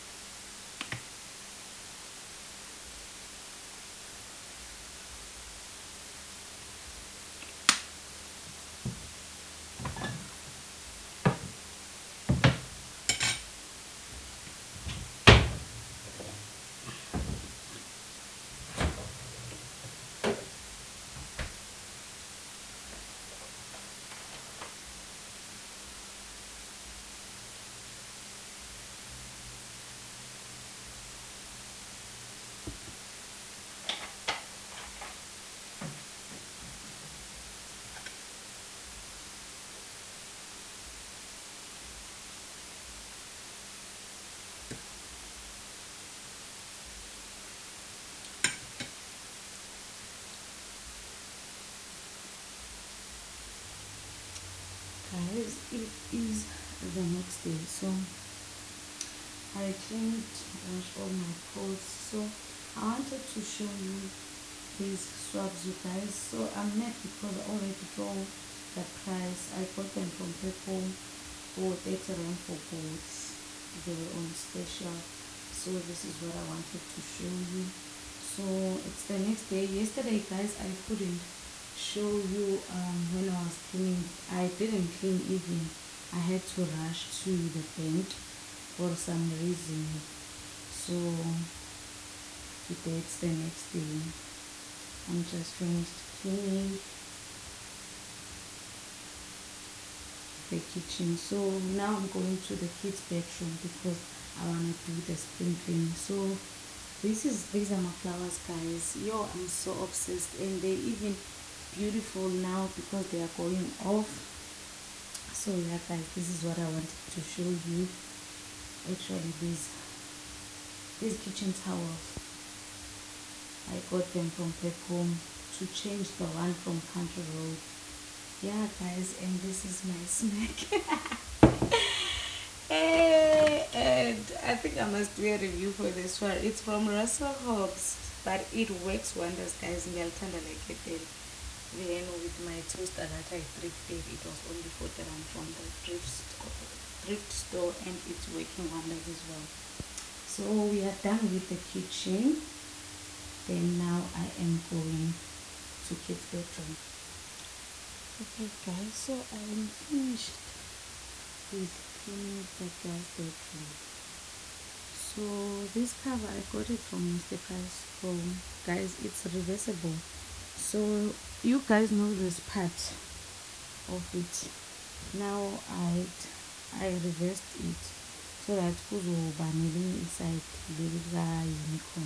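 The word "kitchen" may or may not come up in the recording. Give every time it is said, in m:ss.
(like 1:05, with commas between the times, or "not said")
1:40, 2:01, 2:31.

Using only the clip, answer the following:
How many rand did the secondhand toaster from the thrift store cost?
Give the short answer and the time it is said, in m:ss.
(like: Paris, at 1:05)
40, at 2:24.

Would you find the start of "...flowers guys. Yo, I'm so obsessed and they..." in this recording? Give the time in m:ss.
1:47.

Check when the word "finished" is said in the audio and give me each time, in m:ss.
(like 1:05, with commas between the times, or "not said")
1:35, 2:39.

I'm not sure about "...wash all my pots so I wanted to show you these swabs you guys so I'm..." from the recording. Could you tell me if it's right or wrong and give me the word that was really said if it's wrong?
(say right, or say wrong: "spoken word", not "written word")
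right.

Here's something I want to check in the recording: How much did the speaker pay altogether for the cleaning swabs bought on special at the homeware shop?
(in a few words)
30.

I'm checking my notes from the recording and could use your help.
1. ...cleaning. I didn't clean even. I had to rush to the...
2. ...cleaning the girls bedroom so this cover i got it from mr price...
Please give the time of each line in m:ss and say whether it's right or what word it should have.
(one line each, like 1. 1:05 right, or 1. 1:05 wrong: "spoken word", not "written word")
1. 1:23 right
2. 2:41 right.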